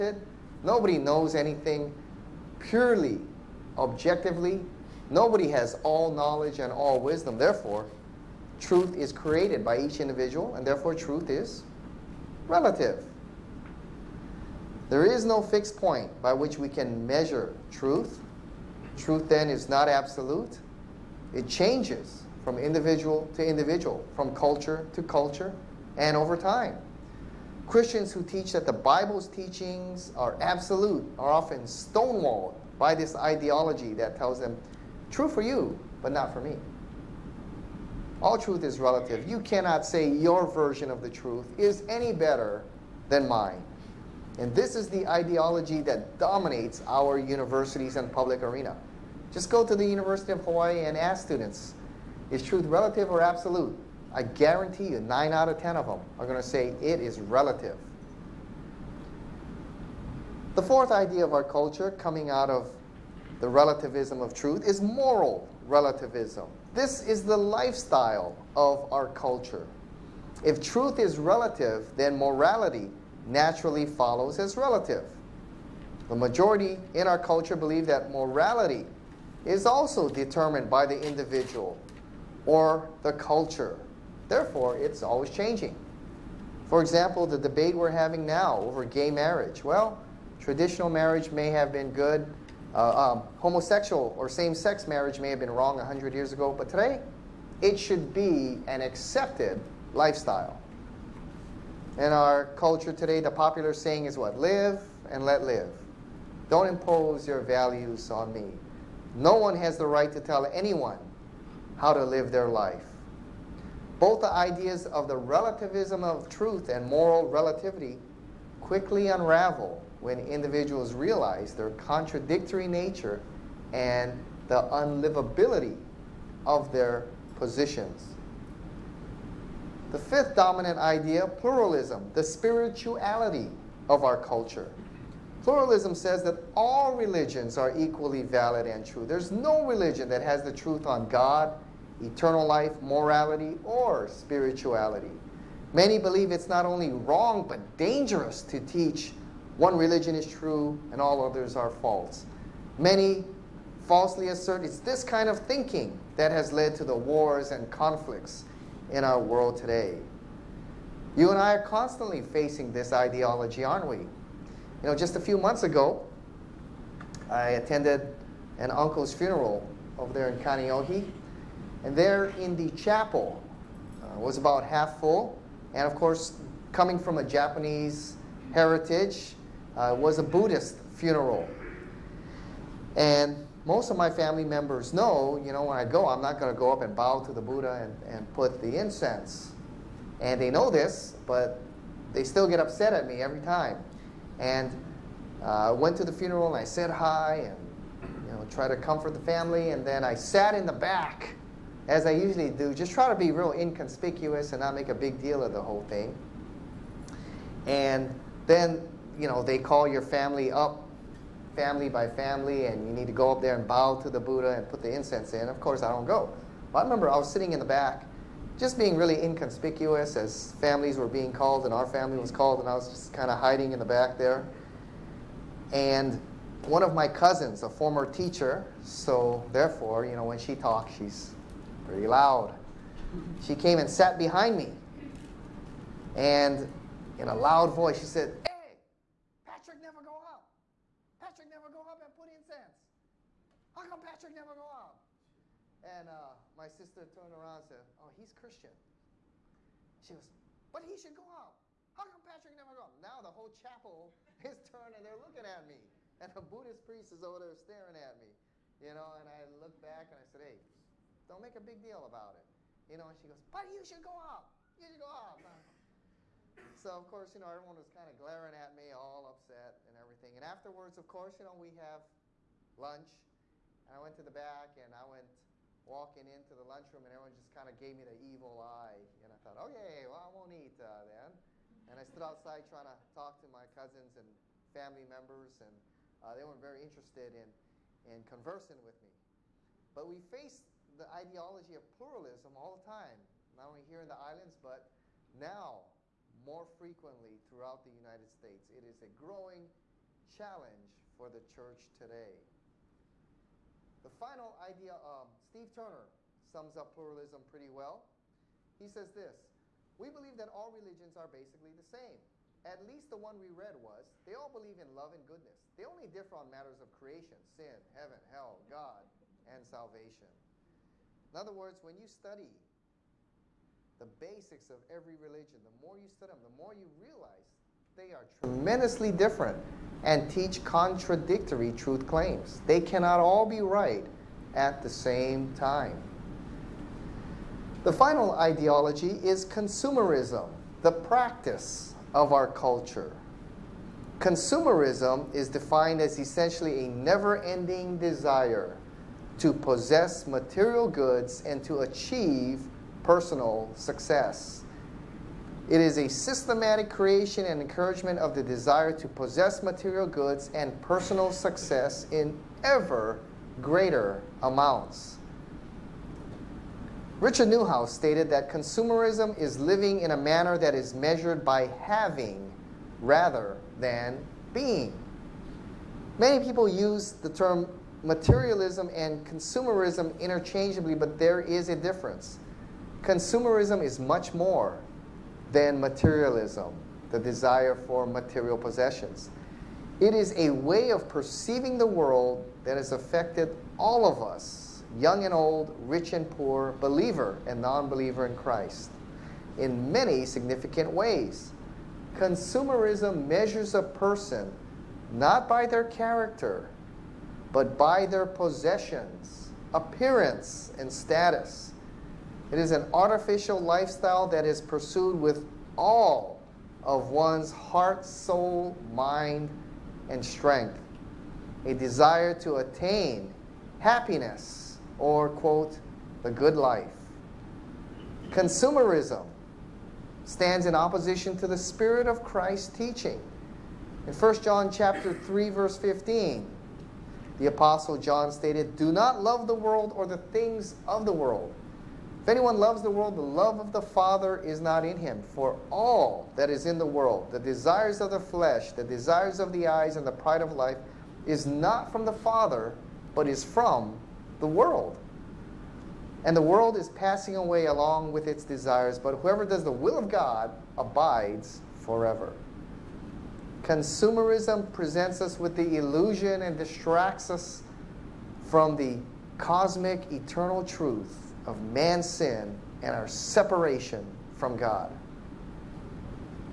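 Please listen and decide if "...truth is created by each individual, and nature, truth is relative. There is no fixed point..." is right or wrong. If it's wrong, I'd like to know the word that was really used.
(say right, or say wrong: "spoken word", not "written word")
wrong: "therefore", not "nature".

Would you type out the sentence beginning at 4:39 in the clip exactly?
And I thought, okay, well, I won't eat uh, then.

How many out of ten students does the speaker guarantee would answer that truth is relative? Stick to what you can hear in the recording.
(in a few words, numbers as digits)
9.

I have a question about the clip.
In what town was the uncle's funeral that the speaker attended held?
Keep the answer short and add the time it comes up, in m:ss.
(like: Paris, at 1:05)
Kaneohe, at 2:50.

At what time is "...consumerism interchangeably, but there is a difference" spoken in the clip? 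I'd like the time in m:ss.
6:19.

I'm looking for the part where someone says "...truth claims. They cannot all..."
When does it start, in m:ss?
5:31.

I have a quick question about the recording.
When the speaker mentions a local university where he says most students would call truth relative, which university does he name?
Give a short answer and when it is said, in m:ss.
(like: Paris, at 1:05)
University of Hawaii, at 0:49.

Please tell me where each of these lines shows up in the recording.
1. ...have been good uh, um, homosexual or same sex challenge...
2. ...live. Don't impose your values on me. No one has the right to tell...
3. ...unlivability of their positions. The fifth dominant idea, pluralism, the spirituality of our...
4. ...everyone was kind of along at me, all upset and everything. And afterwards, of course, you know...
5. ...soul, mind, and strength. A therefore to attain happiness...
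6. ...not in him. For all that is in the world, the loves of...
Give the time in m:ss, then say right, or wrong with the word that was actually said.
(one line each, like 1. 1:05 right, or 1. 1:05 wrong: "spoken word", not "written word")
1. 1:31 wrong: "marriage", not "challenge"
2. 1:45 right
3. 2:04 right
4. 4:27 wrong: "glaring", not "along"
5. 6:58 wrong: "desire", not "therefore"
6. 7:24 wrong: "desires", not "loves".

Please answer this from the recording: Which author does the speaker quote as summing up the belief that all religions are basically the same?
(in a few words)
Steve Turner.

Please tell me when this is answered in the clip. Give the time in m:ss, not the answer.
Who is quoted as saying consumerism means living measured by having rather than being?
6:07.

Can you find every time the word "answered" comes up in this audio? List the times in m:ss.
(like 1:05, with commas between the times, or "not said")
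not said.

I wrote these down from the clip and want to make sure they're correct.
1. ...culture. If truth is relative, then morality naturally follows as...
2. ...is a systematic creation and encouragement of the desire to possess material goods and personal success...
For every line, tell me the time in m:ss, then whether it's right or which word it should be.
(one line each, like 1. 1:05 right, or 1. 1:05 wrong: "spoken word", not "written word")
1. 1:09 right
2. 5:55 right.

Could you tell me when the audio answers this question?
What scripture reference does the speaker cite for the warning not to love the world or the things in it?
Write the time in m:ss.
7:14.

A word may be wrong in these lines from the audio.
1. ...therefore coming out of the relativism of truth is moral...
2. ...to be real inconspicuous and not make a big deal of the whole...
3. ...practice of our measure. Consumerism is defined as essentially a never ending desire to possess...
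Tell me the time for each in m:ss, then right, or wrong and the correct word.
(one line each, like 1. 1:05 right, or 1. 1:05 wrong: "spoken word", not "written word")
1. 1:01 wrong: "culture", not "therefore"
2. 3:23 right
3. 5:40 wrong: "culture", not "measure".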